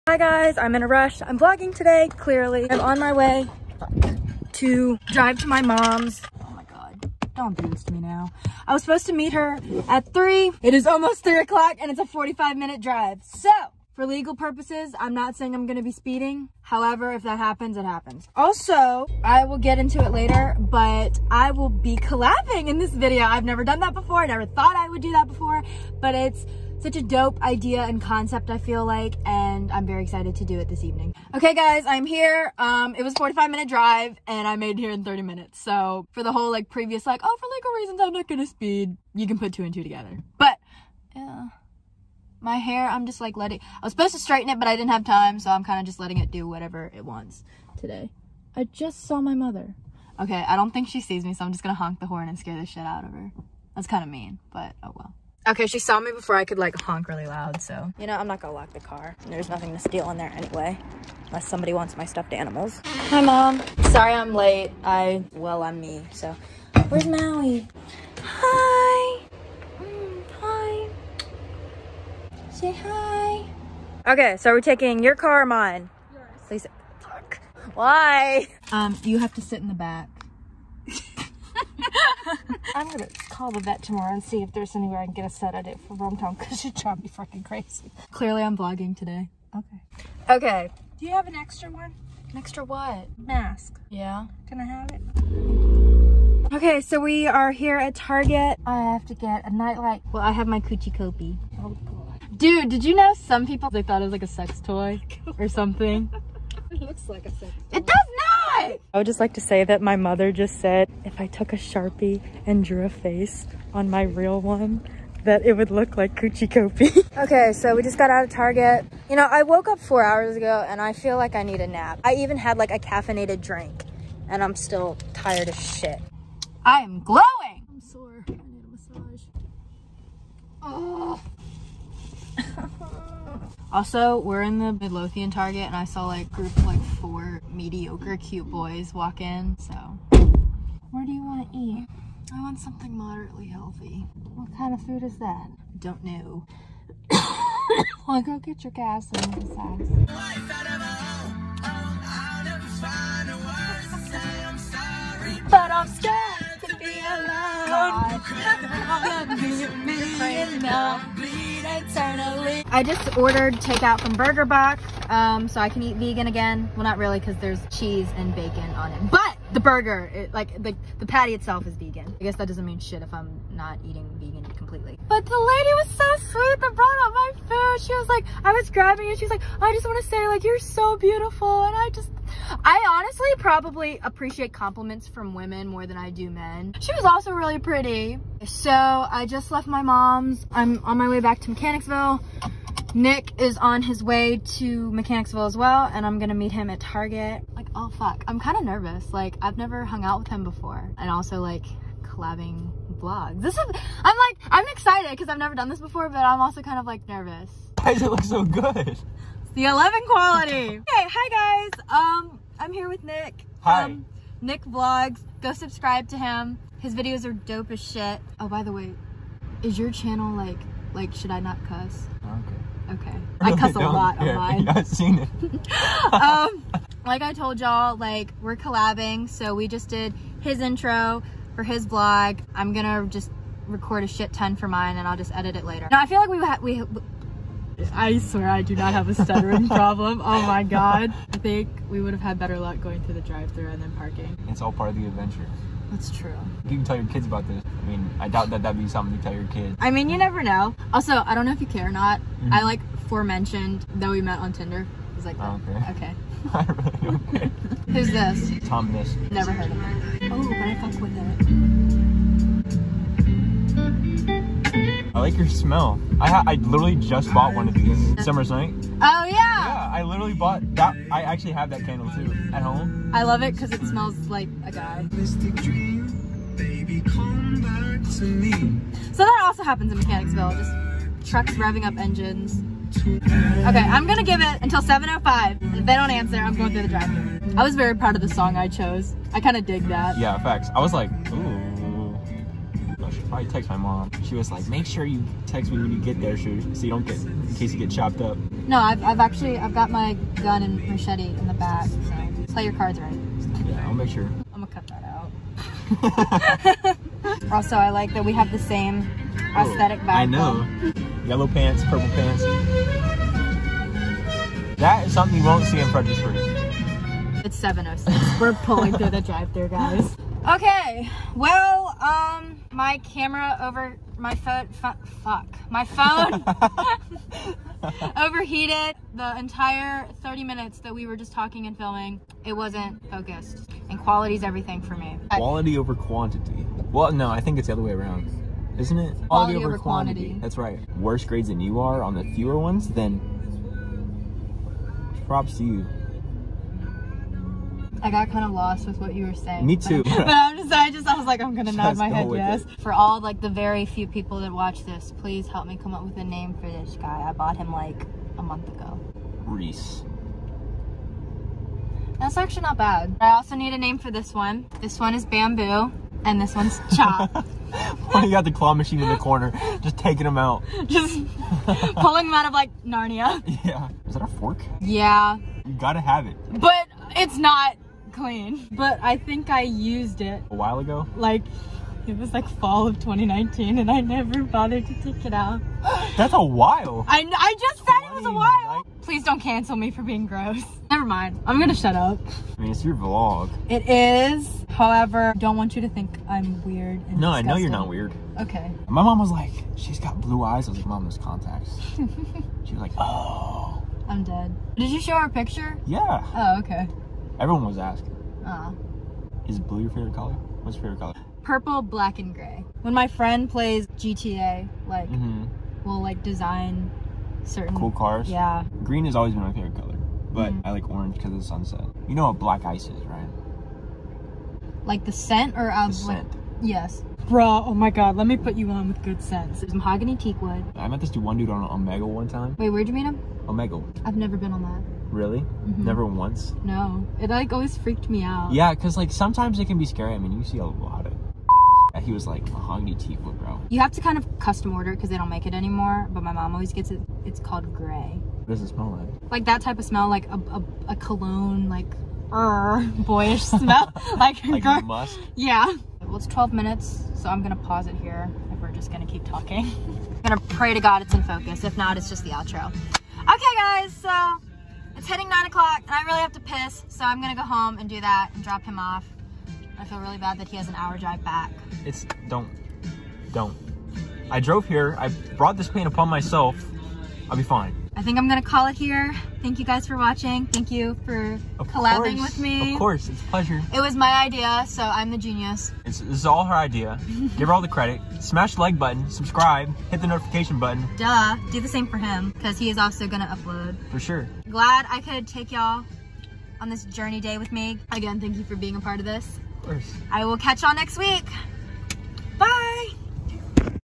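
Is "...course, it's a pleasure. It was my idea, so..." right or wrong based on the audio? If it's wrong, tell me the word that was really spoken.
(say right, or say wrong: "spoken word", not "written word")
right.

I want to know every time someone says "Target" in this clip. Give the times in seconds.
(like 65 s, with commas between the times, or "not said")
97 s, 118 s, 135 s, 196 s.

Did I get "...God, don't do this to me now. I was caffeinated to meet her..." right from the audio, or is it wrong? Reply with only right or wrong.
wrong.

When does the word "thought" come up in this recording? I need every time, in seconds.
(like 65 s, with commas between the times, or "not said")
24 s, 103 s.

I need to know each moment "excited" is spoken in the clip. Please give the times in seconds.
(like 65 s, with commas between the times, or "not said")
30 s, 204 s.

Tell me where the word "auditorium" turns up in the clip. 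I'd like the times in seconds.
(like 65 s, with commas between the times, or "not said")
not said.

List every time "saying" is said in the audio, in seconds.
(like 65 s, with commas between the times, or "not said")
15 s, 349 s.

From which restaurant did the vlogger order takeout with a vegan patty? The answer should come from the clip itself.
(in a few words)
Burger Box.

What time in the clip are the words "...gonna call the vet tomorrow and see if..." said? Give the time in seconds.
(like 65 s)
82 s.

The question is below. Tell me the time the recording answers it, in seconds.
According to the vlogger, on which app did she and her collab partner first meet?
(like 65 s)
254 s.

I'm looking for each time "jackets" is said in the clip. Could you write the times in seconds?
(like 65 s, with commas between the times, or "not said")
not said.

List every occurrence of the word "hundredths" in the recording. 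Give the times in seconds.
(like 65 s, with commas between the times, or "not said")
not said.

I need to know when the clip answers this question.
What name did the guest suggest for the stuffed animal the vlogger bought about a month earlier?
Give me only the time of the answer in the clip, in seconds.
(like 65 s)
359 s.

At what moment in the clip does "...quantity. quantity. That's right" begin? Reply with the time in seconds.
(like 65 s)
339 s.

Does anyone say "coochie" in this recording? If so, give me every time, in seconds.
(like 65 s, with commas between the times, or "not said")
100 s, 116 s.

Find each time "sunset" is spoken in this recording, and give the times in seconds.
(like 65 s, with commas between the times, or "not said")
421 s.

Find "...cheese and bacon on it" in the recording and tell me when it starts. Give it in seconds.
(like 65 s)
167 s.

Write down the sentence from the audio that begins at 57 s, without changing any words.
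You know, I'm not gonna lock the car.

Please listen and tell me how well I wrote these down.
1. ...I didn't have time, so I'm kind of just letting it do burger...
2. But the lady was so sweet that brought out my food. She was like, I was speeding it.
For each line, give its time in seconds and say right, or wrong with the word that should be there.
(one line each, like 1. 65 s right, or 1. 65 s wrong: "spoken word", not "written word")
1. 44 s wrong: "whatever", not "burger"
2. 175 s wrong: "grabbing", not "speeding".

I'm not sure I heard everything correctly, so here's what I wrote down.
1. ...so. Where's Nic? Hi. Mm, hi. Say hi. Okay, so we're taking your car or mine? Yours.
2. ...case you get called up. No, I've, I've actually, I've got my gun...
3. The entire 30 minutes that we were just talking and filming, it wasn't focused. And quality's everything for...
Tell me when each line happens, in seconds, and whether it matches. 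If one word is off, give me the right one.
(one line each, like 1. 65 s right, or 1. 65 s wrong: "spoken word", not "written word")
1. 66 s wrong: "Maui", not "Nic"
2. 297 s wrong: "chopped", not "called"
3. 329 s right.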